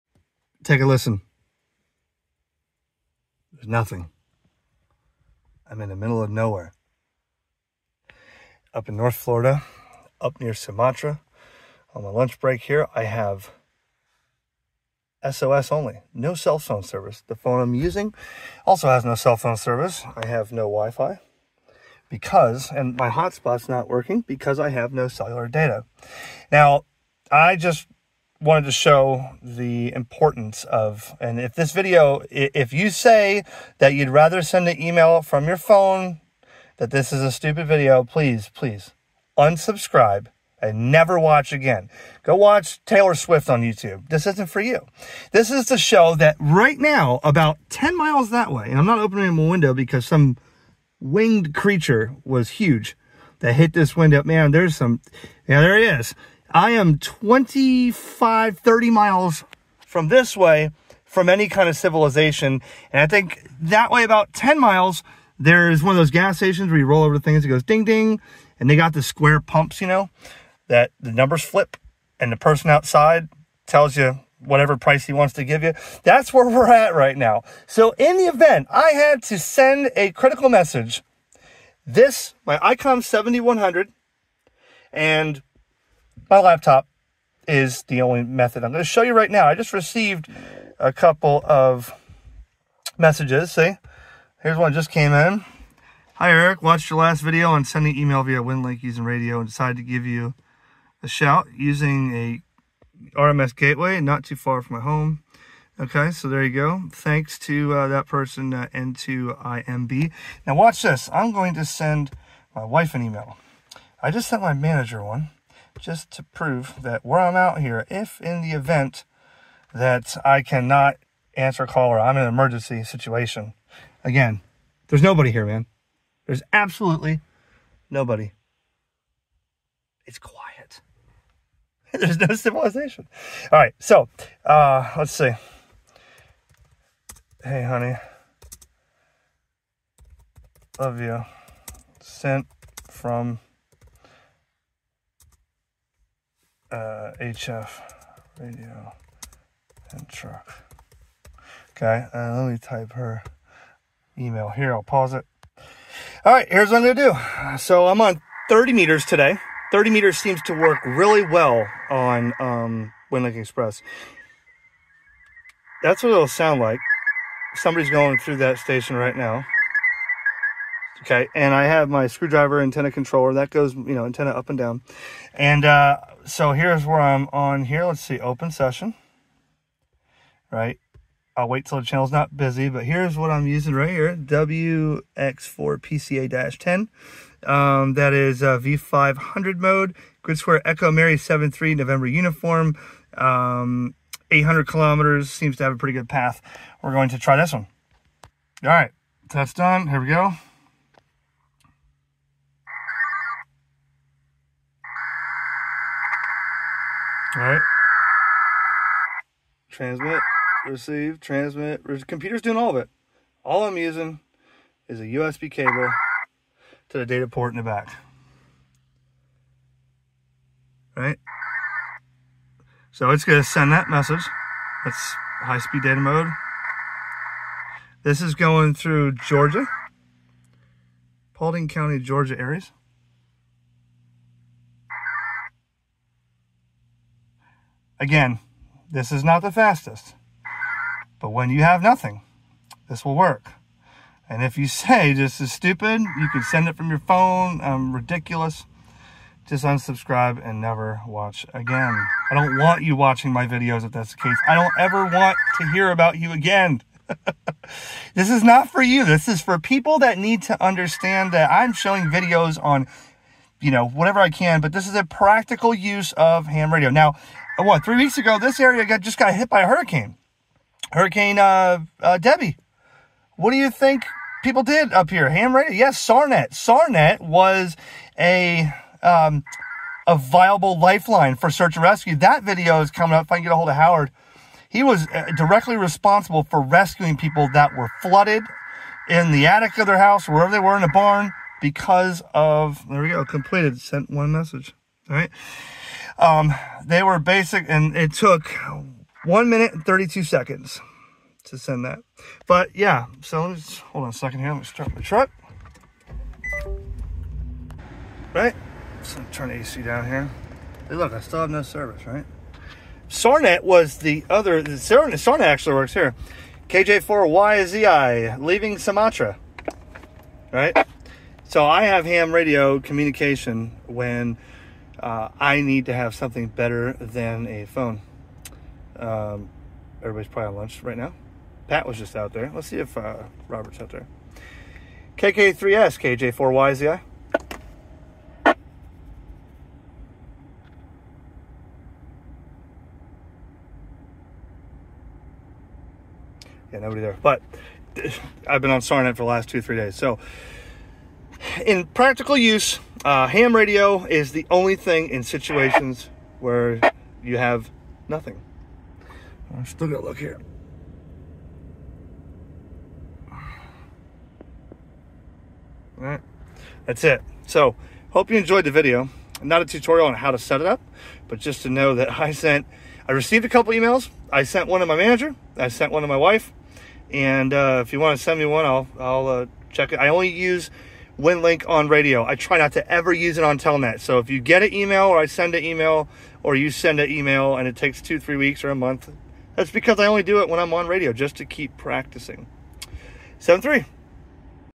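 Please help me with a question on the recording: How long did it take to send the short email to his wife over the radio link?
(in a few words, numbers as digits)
1 minute 32 seconds.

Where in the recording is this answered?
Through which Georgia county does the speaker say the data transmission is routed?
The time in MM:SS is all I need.
03:51.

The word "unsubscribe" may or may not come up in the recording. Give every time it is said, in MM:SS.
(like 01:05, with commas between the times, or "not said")
00:39, 04:09.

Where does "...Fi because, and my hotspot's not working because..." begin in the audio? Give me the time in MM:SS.
00:20.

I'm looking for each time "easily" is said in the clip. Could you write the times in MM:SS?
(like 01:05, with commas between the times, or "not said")
not said.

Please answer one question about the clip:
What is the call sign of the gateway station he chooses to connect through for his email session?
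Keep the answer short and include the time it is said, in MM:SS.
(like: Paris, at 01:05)
WX4PCA-10, at 03:04.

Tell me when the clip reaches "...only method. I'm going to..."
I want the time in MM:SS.
01:28.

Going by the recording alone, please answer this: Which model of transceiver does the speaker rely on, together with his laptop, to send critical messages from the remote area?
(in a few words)
ICOM 7100.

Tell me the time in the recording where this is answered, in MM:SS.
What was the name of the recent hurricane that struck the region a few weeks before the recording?
04:32.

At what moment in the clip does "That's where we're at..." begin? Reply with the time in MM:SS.
01:16.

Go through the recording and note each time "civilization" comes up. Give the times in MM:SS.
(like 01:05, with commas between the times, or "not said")
01:01, 02:12.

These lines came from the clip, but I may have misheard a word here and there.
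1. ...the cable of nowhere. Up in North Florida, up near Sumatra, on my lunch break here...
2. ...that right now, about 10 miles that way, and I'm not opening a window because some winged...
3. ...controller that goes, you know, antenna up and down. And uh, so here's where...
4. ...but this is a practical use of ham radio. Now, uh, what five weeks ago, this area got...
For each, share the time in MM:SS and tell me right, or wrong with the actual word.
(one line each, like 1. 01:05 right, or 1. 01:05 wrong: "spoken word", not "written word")
1. 00:05 wrong: "middle", not "cable"
2. 00:46 right
3. 02:52 right
4. 04:24 wrong: "three", not "five".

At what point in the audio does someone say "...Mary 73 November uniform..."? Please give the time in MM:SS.
03:10.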